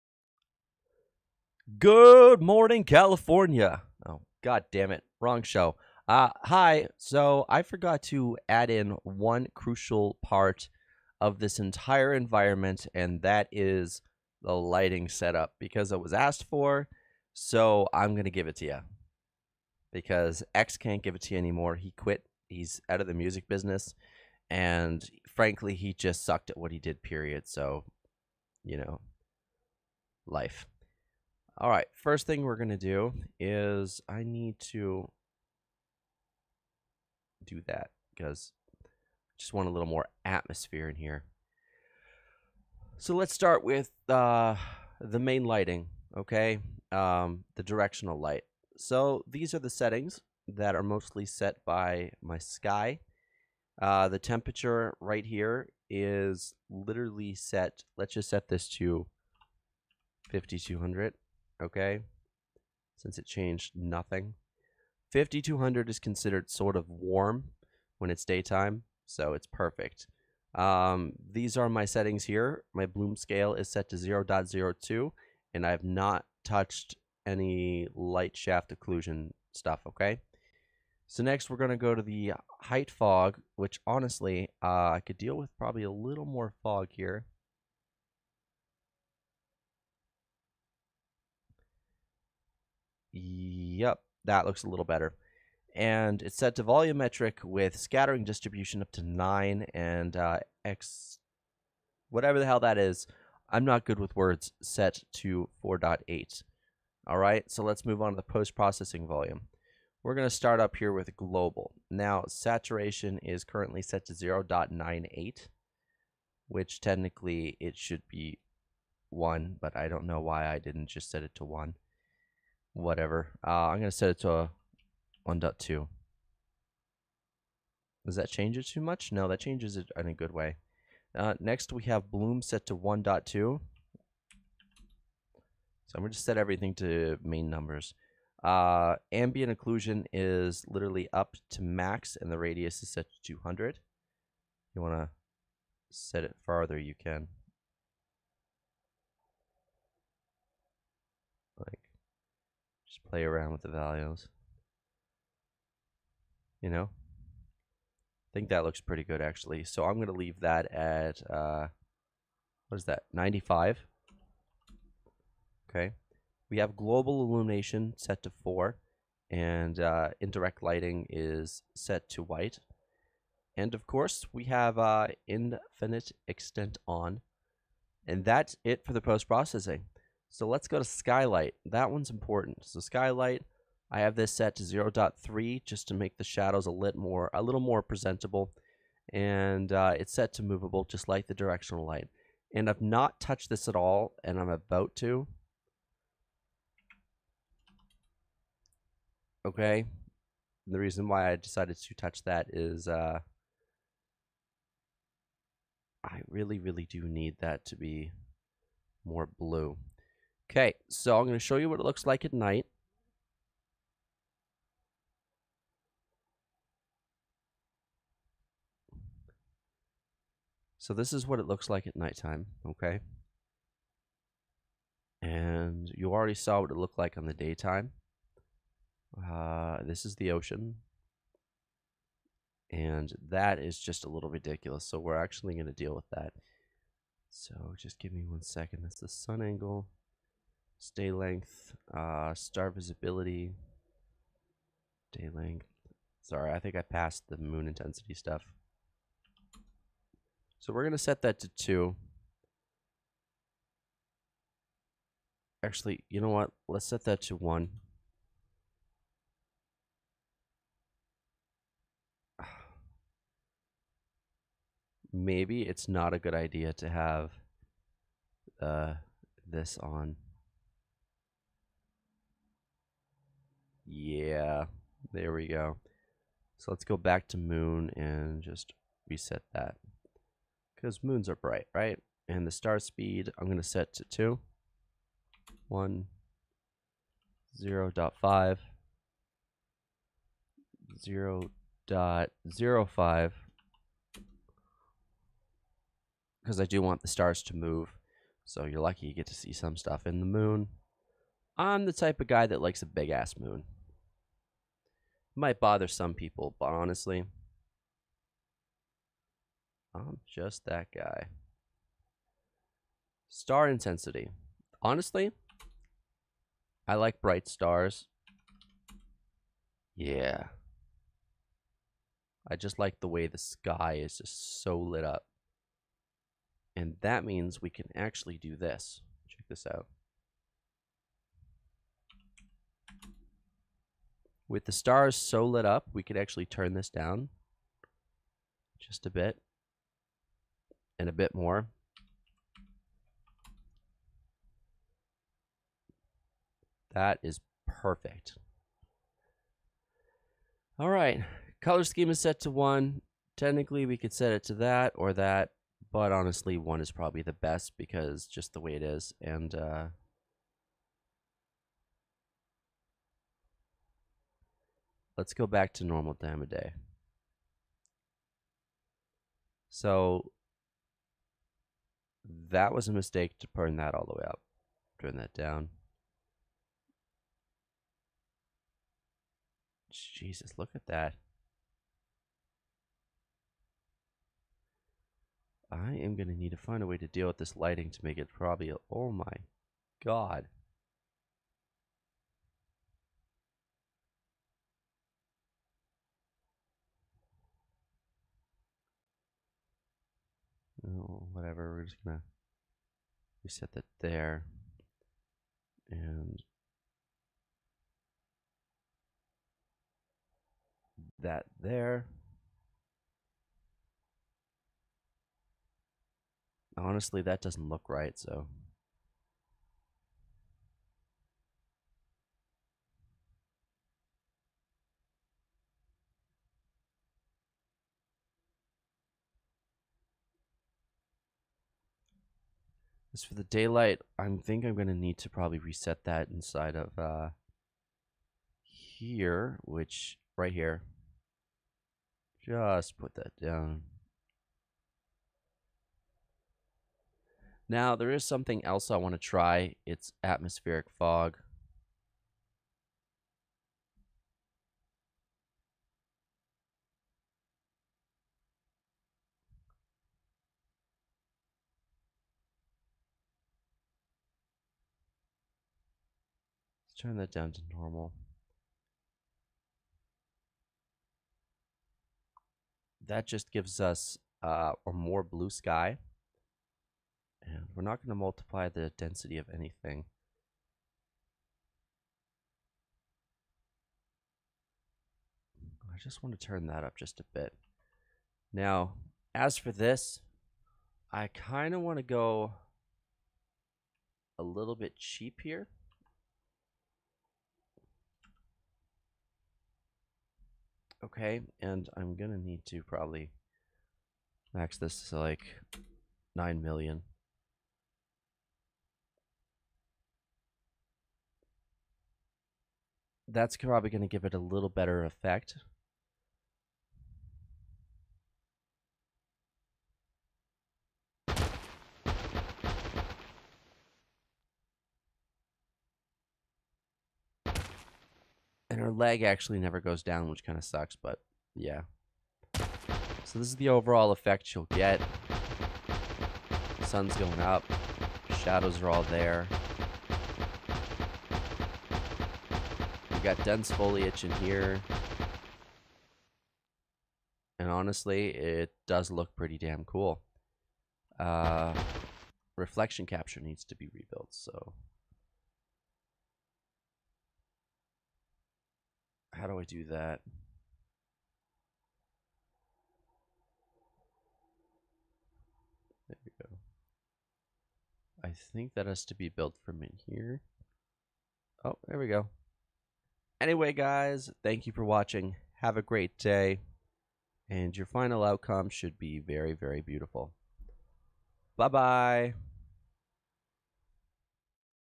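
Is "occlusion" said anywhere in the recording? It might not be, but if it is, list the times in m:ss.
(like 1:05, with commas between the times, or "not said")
1:18, 2:19.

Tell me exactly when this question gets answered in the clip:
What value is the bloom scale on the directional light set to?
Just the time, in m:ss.
1:13.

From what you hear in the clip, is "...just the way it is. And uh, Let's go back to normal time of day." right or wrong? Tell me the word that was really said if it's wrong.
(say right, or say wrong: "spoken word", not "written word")
right.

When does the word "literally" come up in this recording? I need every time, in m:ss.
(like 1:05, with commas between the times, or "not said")
0:56, 2:20.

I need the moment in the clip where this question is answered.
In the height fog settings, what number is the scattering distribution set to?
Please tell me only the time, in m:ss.
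1:37.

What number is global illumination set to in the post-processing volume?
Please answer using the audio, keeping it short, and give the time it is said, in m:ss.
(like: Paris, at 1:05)
4, at 2:46.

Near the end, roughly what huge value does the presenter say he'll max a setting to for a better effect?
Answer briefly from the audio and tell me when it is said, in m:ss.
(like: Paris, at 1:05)
9 million, at 8:26.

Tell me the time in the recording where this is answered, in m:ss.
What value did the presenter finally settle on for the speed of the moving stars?
4:50.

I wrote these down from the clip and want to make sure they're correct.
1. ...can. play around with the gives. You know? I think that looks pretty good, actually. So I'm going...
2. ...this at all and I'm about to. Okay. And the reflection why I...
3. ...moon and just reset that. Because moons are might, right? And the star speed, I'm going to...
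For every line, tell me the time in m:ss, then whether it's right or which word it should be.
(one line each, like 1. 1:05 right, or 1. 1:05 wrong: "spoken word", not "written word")
1. 2:26 wrong: "values", not "gives"
2. 3:13 wrong: "reason", not "reflection"
3. 4:37 wrong: "bright", not "might".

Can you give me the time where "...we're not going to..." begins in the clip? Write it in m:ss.
7:57.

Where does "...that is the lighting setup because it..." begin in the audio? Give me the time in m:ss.
0:13.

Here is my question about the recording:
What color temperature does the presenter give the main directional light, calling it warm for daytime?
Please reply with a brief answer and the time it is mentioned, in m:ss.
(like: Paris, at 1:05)
5200, at 1:00.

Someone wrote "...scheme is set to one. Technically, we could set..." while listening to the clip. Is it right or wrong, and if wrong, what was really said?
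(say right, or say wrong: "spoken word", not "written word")
right.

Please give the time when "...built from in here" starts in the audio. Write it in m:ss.
9:29.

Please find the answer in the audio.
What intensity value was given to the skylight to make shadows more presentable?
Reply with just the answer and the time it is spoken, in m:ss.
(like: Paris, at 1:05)
0.3, at 3:04.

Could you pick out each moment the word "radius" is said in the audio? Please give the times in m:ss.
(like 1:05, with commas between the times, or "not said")
2:22.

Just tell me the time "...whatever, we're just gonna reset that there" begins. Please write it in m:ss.
6:41.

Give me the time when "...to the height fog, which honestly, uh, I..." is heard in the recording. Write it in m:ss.
1:21.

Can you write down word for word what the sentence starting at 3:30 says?
Okay, so I'm going to show you what it looks like at night.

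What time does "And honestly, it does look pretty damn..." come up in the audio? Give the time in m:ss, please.
9:07.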